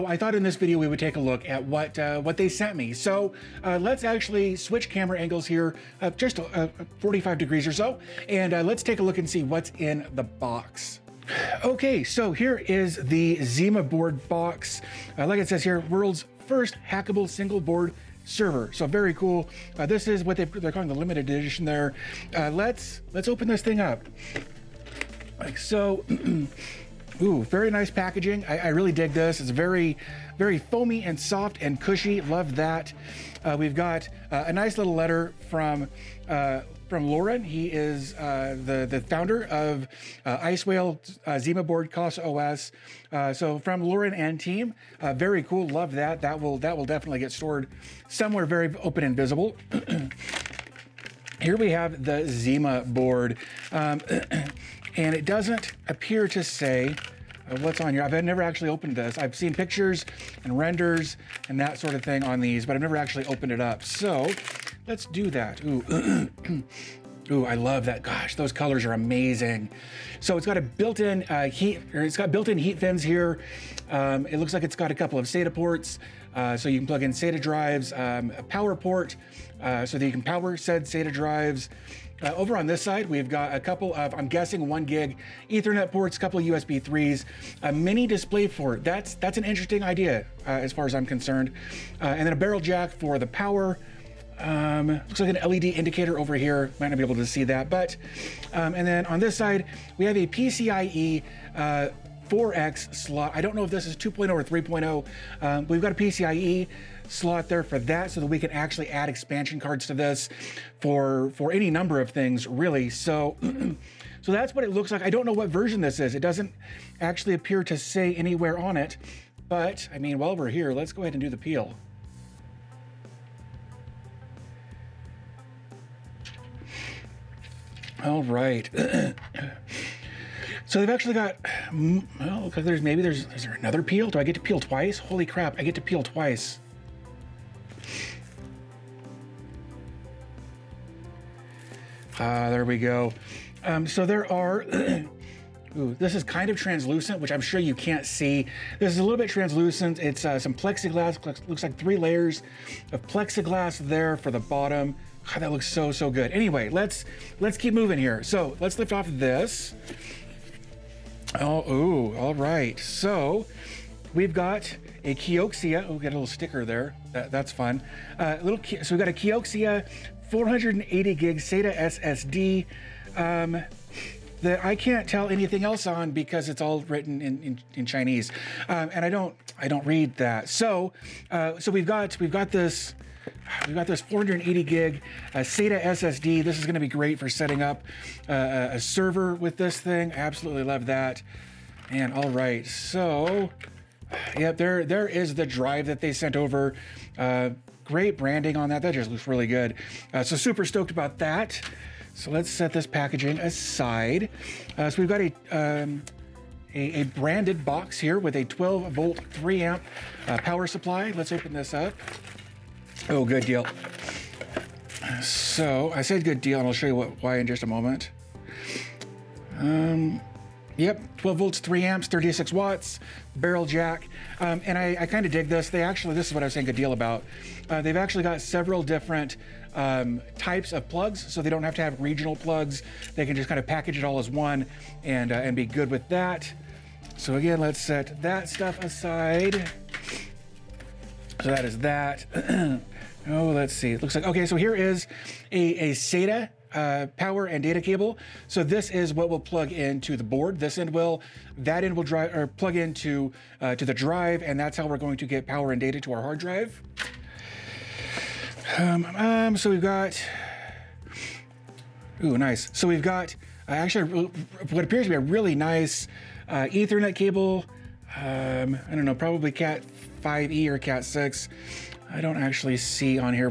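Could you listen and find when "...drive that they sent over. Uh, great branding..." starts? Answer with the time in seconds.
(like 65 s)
195 s.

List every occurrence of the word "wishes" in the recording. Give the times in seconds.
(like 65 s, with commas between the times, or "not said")
not said.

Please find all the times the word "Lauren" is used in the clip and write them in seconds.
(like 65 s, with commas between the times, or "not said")
37 s, 43 s.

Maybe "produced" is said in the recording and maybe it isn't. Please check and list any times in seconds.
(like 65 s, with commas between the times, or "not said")
not said.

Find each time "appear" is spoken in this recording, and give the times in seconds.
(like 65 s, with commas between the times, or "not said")
55 s, 117 s, 264 s.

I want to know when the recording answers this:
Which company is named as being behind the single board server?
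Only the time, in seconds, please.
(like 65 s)
40 s.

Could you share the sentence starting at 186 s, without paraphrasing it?
This is gonna be great for setting up uh, a server with this thing.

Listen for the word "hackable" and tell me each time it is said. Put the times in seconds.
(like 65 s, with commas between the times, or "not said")
16 s.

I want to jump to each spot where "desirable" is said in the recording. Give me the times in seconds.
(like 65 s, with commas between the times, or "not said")
not said.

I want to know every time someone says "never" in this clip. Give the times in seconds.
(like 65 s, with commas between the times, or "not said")
58 s, 62 s.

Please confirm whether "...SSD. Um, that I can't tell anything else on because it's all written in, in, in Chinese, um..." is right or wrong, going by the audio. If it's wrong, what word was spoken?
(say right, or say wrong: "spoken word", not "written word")
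right.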